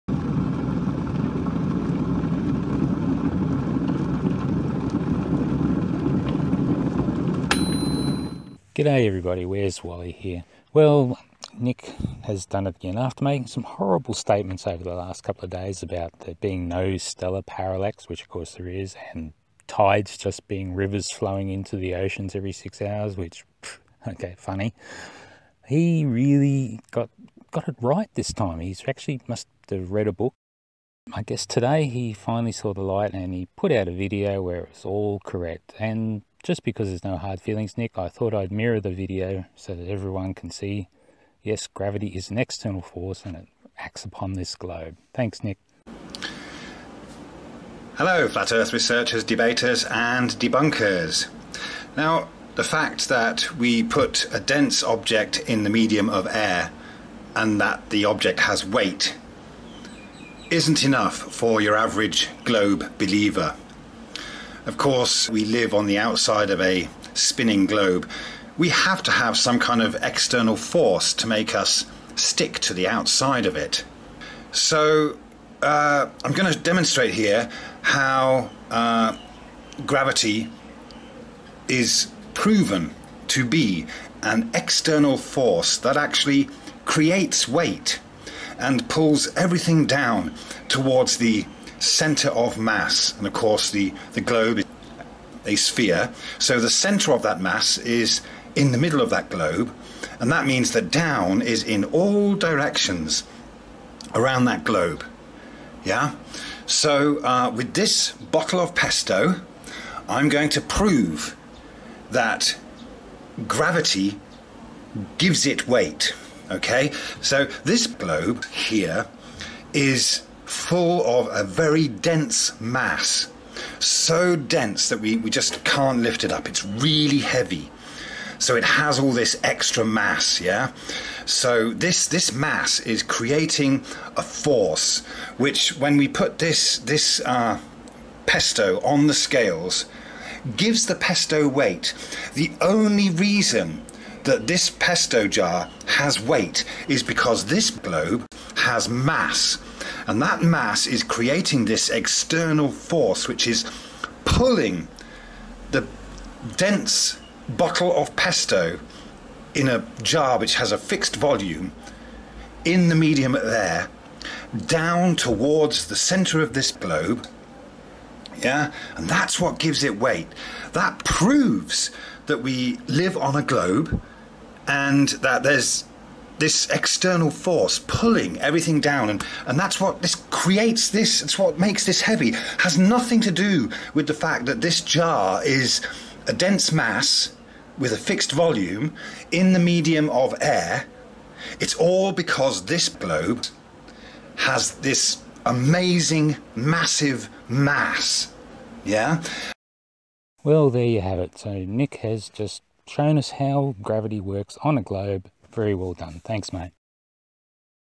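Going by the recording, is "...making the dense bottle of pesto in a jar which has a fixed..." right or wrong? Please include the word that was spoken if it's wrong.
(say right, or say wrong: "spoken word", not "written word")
wrong: "pulling", not "making".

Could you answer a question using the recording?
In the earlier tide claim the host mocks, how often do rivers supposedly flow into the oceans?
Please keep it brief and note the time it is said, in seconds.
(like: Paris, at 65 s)
every six hours, at 22 s.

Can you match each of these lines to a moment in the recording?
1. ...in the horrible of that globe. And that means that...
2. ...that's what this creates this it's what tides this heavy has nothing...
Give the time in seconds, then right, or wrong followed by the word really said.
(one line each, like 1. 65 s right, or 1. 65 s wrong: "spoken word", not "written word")
1. 98 s wrong: "middle", not "horrible"
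2. 179 s wrong: "makes", not "tides".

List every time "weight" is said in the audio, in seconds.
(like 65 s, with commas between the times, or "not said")
58 s, 87 s, 115 s, 141 s, 146 s, 169 s.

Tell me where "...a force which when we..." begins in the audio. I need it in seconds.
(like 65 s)
134 s.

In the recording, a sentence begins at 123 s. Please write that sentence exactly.
So dense that we, we just can't lift it up.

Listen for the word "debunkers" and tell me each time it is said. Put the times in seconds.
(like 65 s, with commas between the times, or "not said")
50 s.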